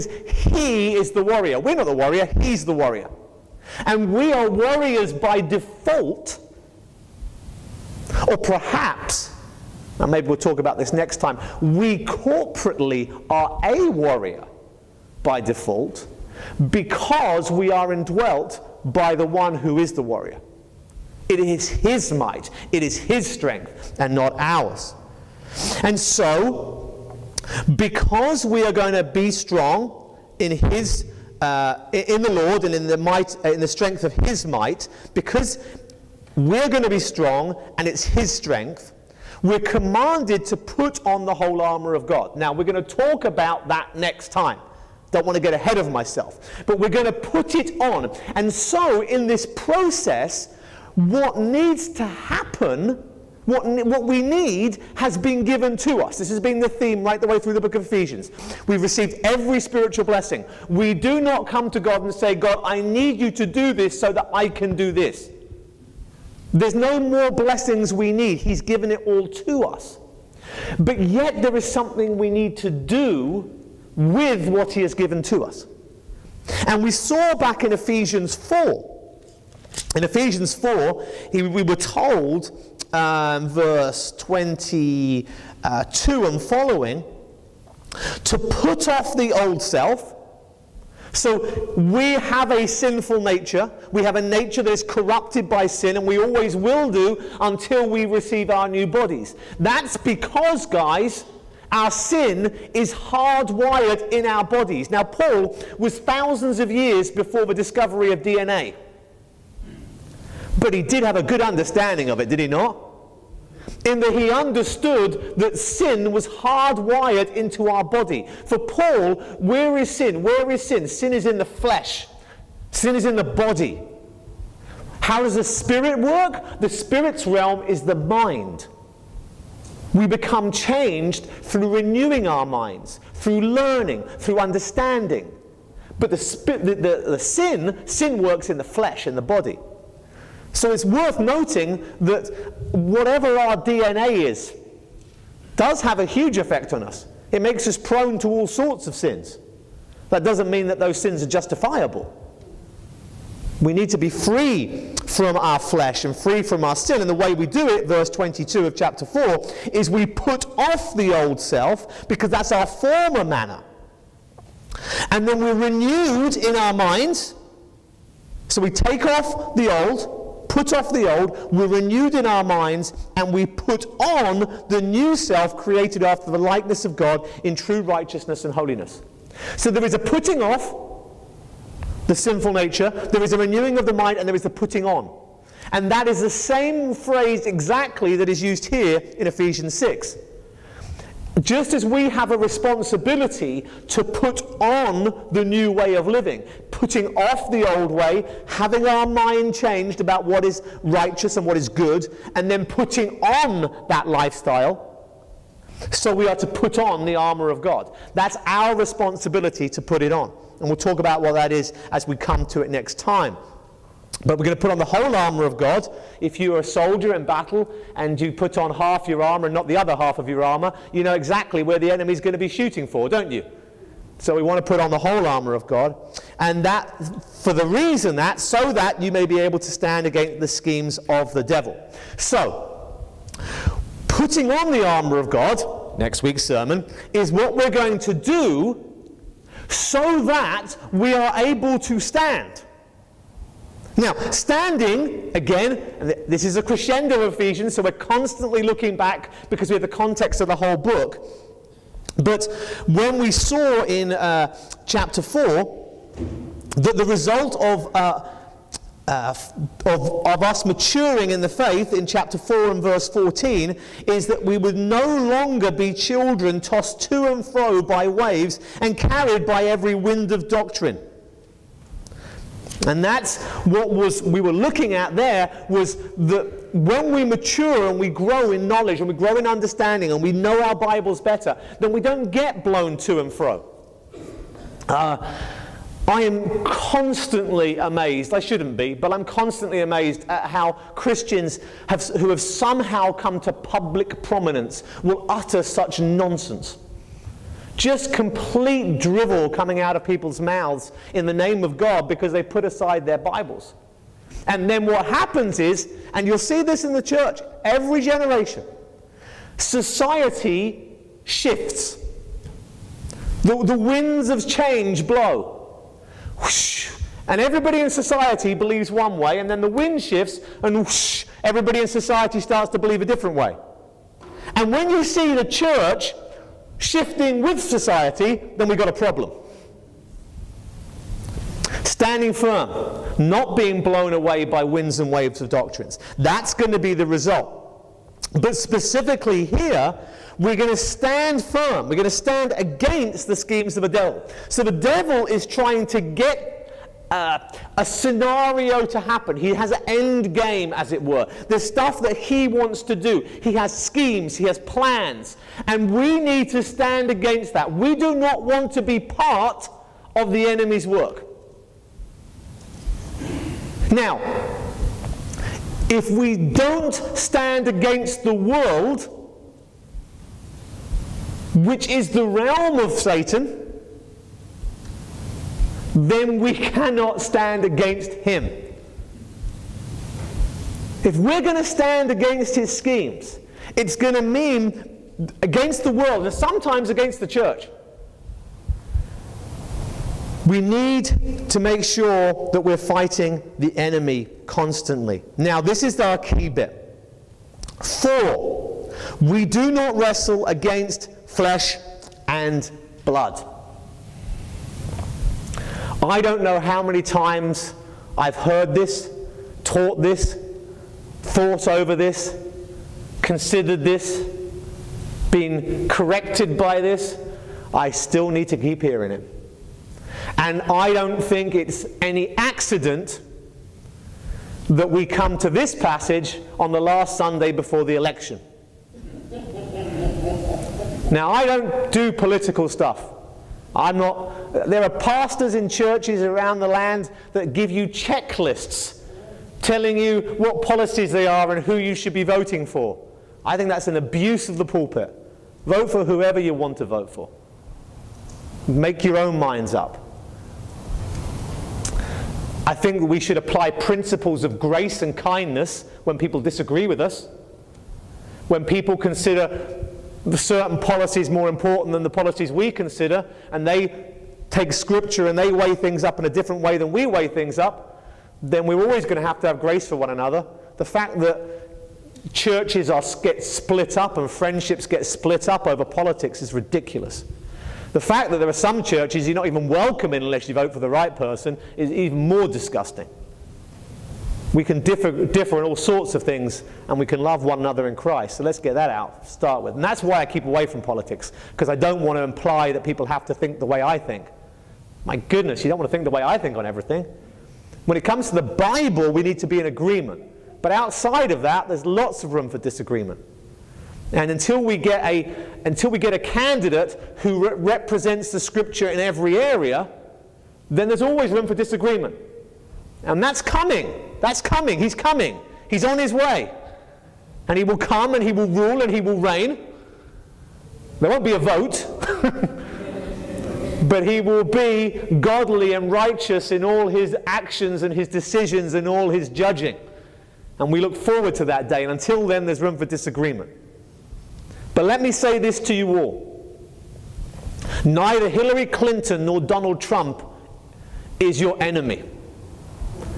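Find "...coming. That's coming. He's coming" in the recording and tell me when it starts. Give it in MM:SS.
08:33.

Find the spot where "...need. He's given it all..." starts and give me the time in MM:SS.
01:08.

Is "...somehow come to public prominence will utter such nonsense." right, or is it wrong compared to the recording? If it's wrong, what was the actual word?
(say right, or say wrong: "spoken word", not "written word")
right.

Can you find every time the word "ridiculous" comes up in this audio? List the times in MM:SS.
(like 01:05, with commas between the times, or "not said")
07:56.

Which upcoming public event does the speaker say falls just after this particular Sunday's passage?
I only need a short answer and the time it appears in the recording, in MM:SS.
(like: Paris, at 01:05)
The election, at 07:07.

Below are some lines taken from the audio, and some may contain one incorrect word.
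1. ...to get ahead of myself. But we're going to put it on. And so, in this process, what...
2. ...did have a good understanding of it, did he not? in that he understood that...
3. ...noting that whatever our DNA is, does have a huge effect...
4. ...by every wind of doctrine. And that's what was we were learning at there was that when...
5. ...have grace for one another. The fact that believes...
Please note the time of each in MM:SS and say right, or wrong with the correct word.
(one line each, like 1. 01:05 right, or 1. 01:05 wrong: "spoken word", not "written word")
1. 00:45 right
2. 01:50 right
3. 02:21 right
4. 04:29 wrong: "looking", not "learning"
5. 07:49 wrong: "churches", not "believes".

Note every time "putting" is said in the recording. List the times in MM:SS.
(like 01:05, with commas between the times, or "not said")
02:59, 03:04, 03:16, 03:22, 03:54.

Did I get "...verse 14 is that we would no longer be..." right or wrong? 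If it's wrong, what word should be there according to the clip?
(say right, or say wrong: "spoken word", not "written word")
right.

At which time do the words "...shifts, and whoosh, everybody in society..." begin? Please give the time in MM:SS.
05:20.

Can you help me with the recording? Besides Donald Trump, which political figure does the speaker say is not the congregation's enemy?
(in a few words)
Hillary Clinton.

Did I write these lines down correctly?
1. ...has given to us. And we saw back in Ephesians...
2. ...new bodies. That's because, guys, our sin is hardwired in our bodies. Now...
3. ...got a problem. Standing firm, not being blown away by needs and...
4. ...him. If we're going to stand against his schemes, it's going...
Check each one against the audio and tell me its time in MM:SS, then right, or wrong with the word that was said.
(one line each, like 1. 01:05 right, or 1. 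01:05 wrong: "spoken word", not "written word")
1. 01:14 right
2. 01:38 right
3. 05:28 wrong: "winds", not "needs"
4. 06:18 right.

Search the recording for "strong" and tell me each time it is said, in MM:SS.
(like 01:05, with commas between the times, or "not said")
00:29, 00:36.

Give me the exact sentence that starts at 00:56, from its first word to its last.
This has been the theme right the way through the book of Ephesians.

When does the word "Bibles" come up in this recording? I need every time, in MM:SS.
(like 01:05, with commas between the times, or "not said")
04:40, 05:03, 08:18.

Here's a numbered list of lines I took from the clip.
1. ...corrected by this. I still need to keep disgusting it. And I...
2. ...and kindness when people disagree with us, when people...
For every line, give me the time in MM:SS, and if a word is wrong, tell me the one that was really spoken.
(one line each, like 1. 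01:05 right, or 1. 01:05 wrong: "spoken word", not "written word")
1. 06:55 wrong: "hearing", not "disgusting"
2. 07:34 right.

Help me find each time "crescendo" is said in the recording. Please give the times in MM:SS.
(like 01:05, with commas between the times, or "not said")
04:06.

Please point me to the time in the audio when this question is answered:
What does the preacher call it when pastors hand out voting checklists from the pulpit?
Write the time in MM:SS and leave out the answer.
07:23.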